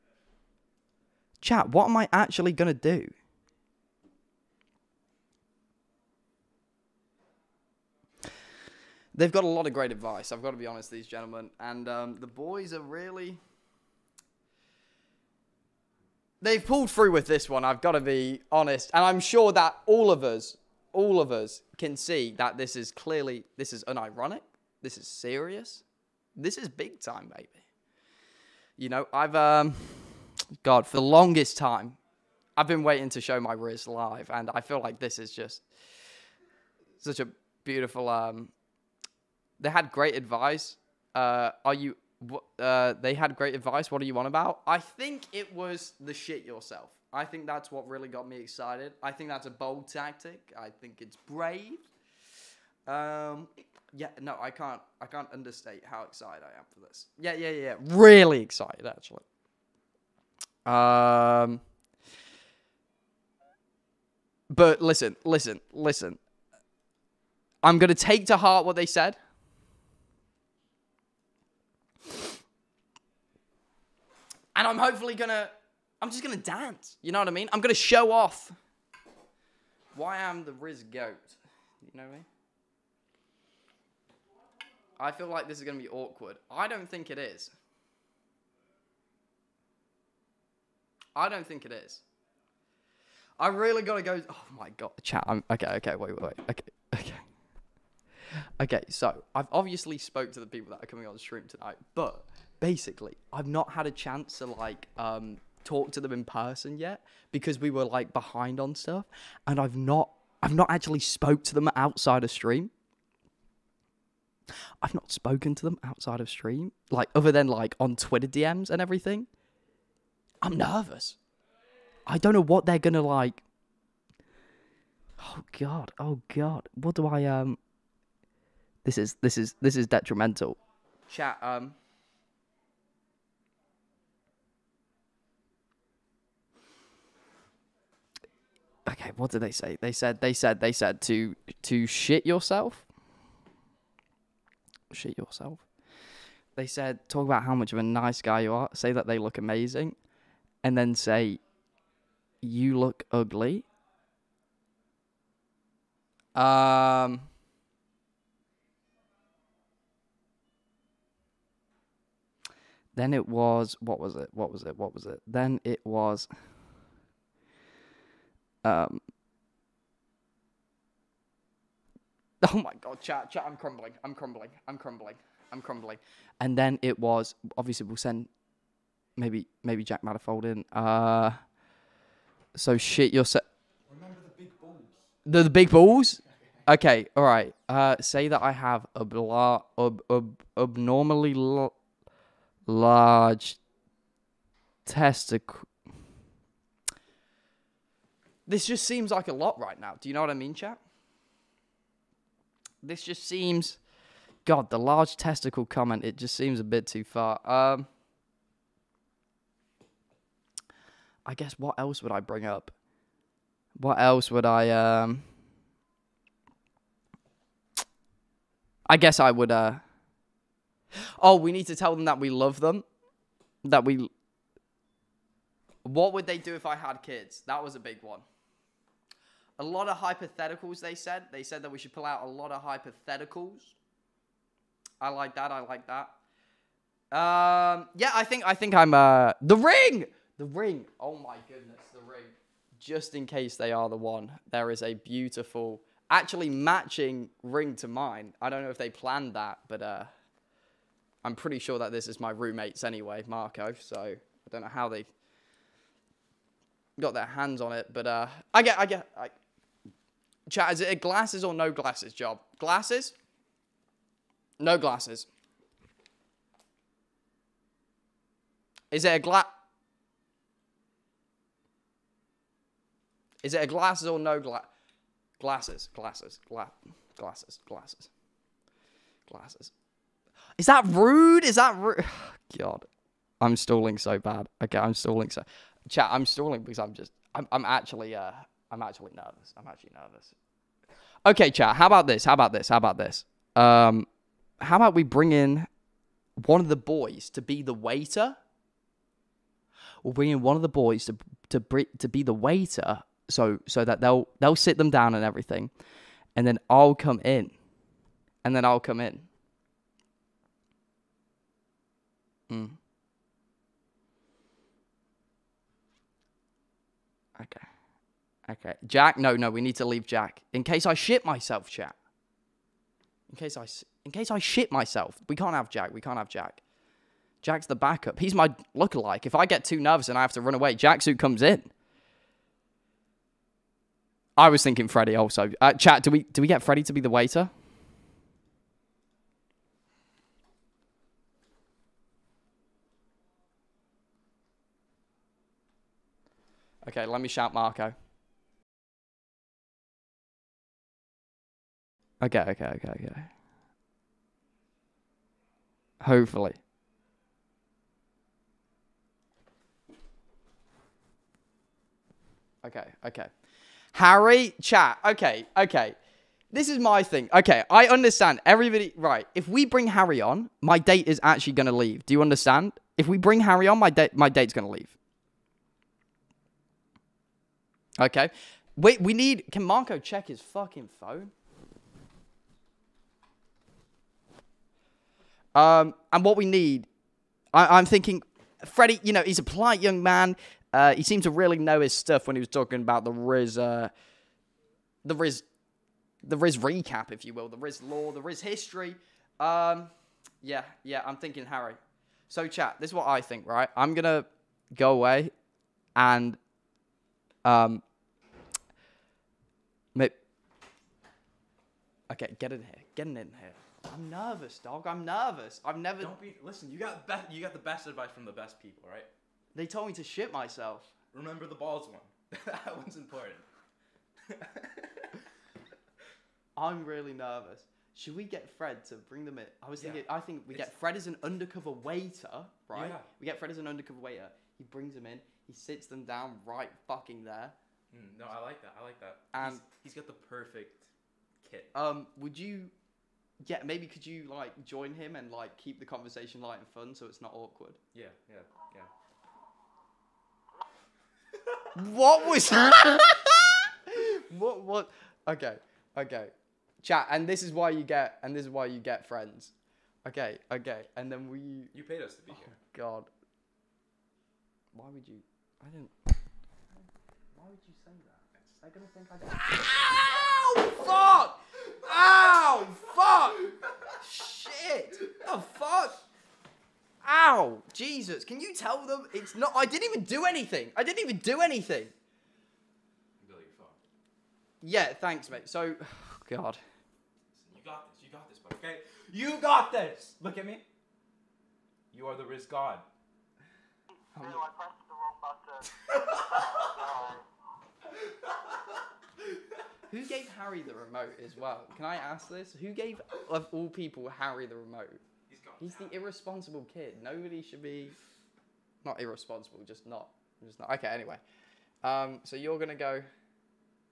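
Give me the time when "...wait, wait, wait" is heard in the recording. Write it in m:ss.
1:35.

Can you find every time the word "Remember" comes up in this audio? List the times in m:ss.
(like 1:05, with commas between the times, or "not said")
3:03, 7:01.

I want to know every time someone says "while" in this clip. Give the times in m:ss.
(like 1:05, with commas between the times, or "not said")
not said.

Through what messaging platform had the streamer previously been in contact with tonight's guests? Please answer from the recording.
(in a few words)
Twitter DMs.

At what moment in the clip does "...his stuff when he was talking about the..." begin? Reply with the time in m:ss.
6:31.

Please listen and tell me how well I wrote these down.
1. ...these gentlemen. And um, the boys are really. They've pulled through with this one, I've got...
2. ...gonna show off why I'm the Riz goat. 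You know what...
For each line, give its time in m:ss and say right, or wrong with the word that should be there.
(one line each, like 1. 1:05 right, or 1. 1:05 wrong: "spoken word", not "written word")
1. 0:10 right
2. 1:17 right.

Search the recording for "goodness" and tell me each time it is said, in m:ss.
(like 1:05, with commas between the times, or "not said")
4:01.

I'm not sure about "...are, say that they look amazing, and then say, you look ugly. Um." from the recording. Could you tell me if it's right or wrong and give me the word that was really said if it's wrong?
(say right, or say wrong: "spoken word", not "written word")
right.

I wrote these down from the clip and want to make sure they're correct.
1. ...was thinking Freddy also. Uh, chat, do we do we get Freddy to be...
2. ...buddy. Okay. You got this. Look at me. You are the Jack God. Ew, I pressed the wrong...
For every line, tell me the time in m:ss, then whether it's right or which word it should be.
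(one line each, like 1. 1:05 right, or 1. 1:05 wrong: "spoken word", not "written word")
1. 5:34 right
2. 8:08 wrong: "Riz", not "Jack".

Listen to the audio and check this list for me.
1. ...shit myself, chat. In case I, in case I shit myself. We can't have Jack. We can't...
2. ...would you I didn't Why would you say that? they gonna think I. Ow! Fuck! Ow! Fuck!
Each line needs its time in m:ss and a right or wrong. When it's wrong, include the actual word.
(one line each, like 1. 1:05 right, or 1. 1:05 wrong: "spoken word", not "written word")
1. 5:20 right
2. 7:44 right.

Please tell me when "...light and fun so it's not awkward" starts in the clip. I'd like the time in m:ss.
7:26.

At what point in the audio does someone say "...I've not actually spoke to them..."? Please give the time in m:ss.
1:50.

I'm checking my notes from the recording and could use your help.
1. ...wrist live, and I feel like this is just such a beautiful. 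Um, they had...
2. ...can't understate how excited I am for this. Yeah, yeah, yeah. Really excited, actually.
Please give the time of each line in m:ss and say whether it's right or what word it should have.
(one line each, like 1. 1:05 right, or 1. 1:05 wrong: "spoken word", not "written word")
1. 0:33 right
2. 0:55 right.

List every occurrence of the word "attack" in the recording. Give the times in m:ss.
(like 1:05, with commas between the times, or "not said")
not said.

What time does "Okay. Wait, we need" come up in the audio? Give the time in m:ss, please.
6:17.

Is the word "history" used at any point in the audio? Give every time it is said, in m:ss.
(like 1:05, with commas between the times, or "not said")
6:38.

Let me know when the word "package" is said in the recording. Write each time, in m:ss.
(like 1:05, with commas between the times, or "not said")
not said.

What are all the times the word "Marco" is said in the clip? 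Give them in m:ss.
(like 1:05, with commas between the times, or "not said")
4:13, 5:47, 6:19.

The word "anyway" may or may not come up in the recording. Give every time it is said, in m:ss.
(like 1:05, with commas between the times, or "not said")
4:12, 8:30.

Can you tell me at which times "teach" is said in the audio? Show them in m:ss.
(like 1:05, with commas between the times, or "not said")
not said.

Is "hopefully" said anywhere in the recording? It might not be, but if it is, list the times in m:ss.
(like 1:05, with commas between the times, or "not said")
1:14, 5:56.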